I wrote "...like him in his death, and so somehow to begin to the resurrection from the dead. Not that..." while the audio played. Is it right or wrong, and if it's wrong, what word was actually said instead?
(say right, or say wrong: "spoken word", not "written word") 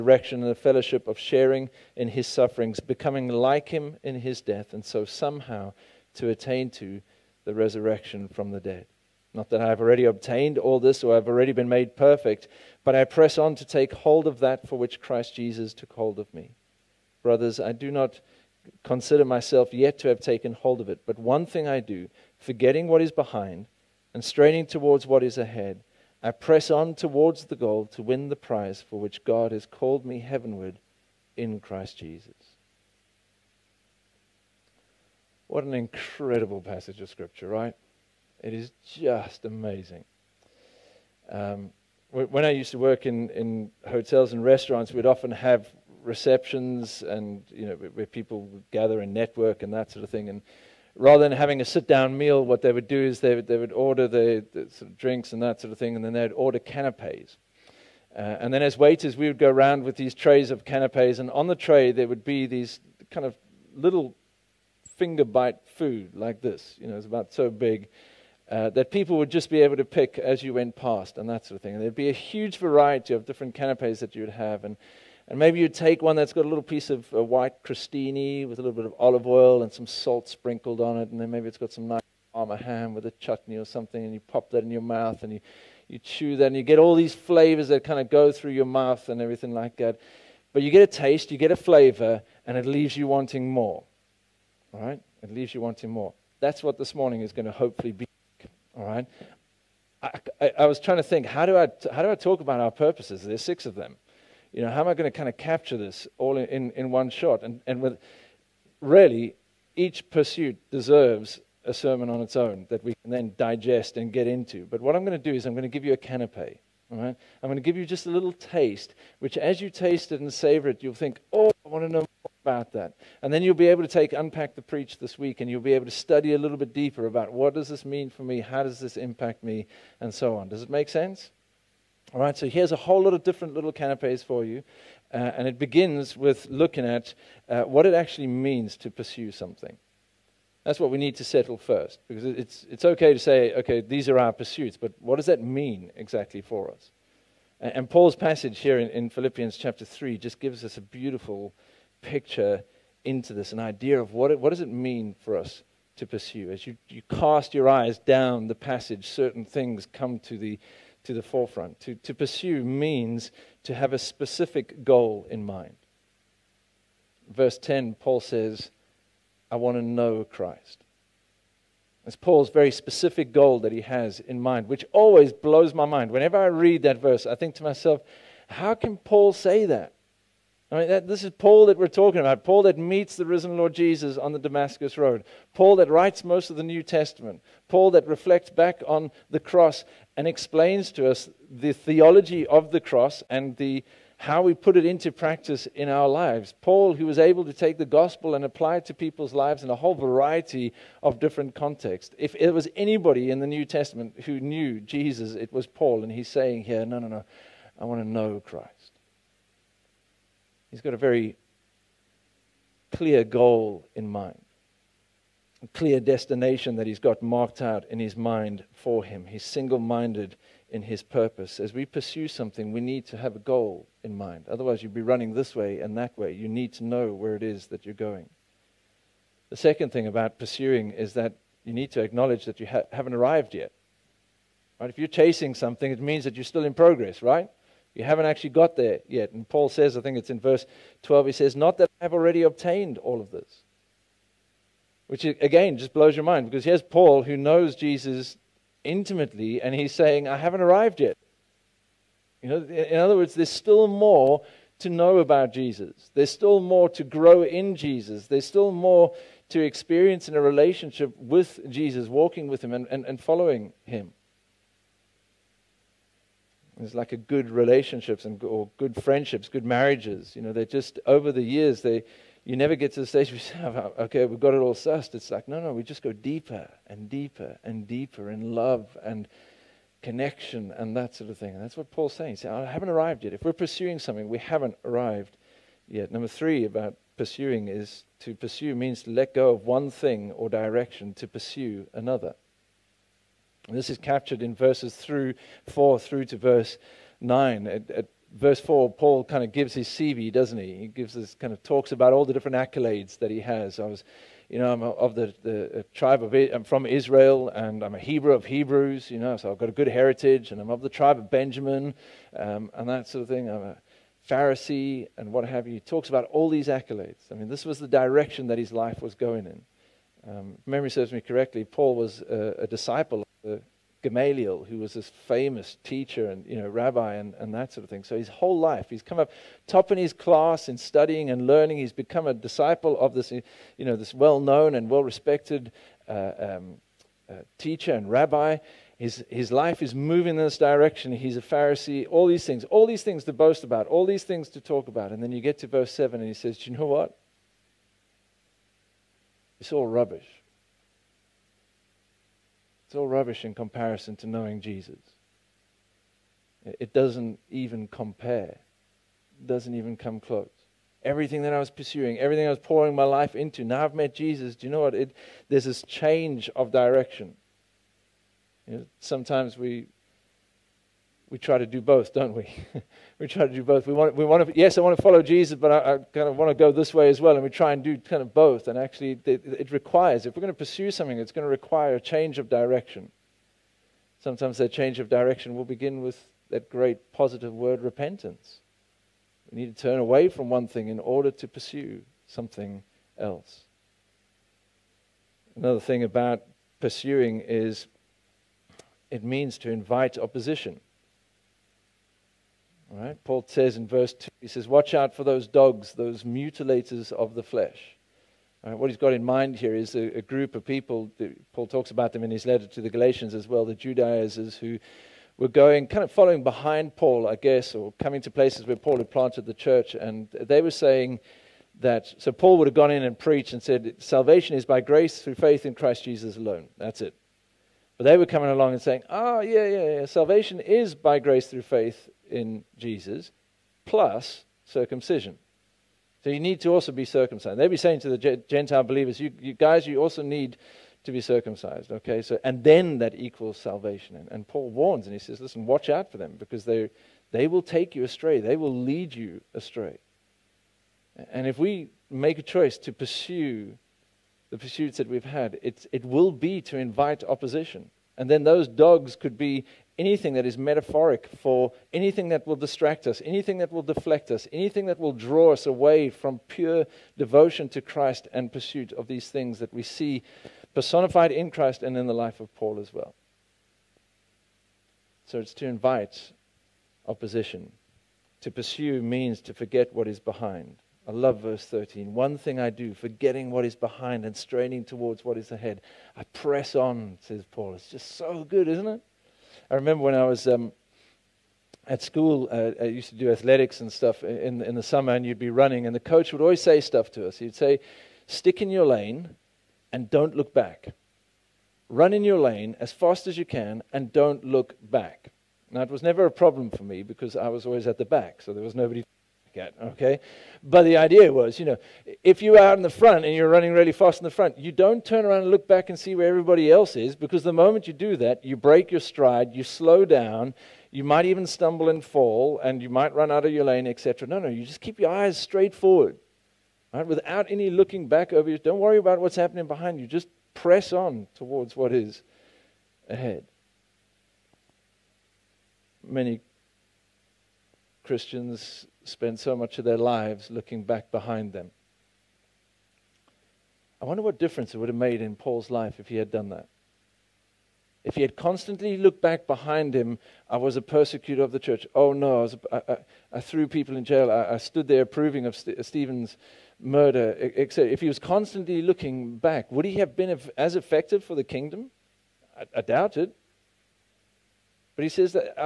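wrong: "attain", not "begin".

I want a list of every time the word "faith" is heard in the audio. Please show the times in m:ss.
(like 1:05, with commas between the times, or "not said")
7:05, 7:11.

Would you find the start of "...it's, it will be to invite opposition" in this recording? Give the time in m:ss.
7:35.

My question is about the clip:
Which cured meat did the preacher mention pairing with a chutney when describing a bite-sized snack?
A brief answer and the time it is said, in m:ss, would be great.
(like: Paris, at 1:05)
Parma ham, at 1:22.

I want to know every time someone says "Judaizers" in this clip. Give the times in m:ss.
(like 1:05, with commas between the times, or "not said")
6:53.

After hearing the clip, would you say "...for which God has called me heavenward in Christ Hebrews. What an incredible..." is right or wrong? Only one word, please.
wrong.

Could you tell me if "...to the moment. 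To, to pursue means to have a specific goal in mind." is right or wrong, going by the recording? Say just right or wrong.
wrong.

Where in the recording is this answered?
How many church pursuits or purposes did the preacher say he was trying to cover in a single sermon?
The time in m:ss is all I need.
1:43.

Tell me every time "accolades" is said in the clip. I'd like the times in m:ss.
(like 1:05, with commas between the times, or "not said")
5:02, 5:16.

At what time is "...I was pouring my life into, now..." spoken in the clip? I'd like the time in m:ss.
6:02.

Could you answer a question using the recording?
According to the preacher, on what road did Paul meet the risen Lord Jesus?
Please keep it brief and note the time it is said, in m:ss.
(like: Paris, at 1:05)
Damascus Road, at 3:04.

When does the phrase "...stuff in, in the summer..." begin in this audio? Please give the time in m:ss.
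8:13.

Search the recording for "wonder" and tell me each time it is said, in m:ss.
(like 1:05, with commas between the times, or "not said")
9:04.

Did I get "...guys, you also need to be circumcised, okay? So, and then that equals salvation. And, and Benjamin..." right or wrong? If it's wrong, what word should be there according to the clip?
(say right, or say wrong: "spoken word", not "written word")
wrong: "Paul", not "Benjamin".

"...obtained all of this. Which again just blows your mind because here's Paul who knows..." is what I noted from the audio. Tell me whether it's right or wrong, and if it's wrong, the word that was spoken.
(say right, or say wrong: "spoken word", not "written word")
right.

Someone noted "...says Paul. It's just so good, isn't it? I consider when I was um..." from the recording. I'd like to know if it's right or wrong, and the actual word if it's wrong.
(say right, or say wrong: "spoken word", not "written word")
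wrong: "remember", not "consider".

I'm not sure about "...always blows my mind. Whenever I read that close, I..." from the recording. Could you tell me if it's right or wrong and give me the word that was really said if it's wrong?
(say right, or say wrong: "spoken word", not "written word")
wrong: "verse", not "close".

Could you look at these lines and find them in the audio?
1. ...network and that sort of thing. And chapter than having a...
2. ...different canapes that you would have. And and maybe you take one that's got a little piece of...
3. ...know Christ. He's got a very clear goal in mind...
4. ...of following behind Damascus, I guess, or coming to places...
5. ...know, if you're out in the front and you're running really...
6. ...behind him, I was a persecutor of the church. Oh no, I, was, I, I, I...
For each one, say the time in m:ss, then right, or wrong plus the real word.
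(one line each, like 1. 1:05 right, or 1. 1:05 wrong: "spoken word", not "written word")
1. 0:49 wrong: "rather", not "chapter"
2. 1:13 right
3. 3:28 right
4. 6:56 wrong: "Paul", not "Damascus"
5. 8:31 right
6. 9:09 right.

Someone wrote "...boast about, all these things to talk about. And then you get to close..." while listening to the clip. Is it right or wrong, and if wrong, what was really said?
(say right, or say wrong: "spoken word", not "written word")
wrong: "verse", not "close".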